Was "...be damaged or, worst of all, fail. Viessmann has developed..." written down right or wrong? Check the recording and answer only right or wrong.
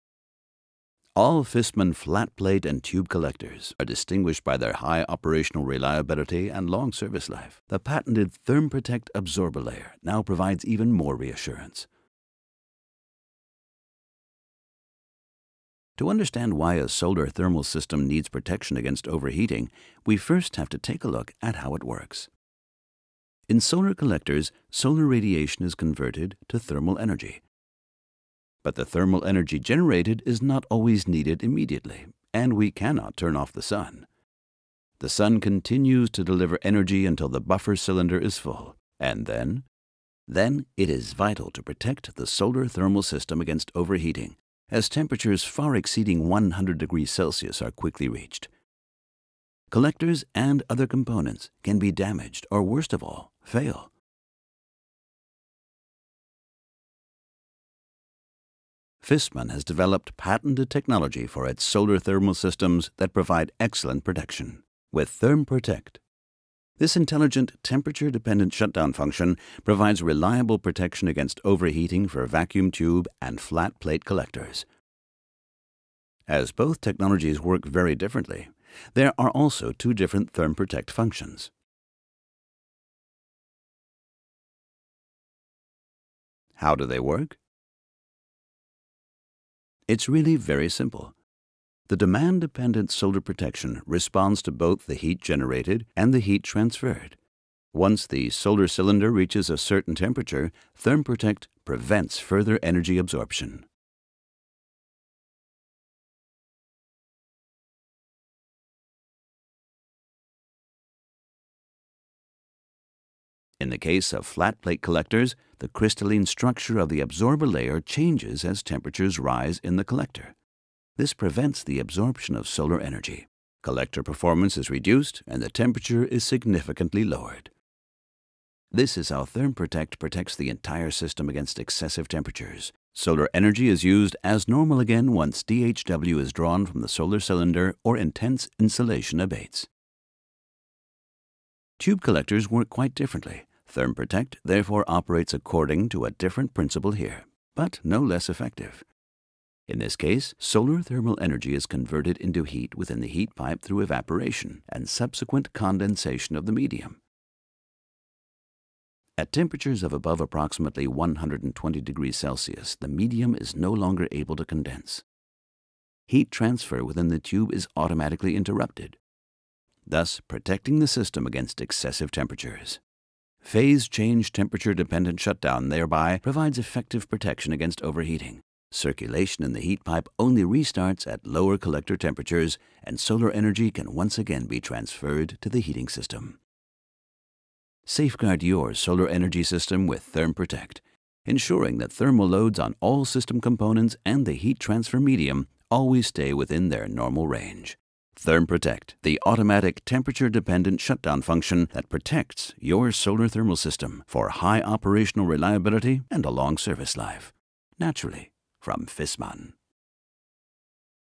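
right.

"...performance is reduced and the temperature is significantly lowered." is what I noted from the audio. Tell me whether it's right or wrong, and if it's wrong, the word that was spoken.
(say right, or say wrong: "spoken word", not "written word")
right.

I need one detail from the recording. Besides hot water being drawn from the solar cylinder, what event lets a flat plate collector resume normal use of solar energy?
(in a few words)
intense insolation abates.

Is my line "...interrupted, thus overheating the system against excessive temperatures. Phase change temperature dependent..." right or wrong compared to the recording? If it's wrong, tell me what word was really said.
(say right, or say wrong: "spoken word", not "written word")
wrong: "protecting", not "overheating".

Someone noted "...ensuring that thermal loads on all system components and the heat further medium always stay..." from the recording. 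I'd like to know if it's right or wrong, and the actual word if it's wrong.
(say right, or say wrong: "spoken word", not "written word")
wrong: "transfer", not "further".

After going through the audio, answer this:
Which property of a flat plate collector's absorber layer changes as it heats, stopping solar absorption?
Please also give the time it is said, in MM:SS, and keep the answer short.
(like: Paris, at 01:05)
crystalline structure, at 01:55.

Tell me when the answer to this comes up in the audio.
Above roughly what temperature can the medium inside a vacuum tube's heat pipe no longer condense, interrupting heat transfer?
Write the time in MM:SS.
02:40.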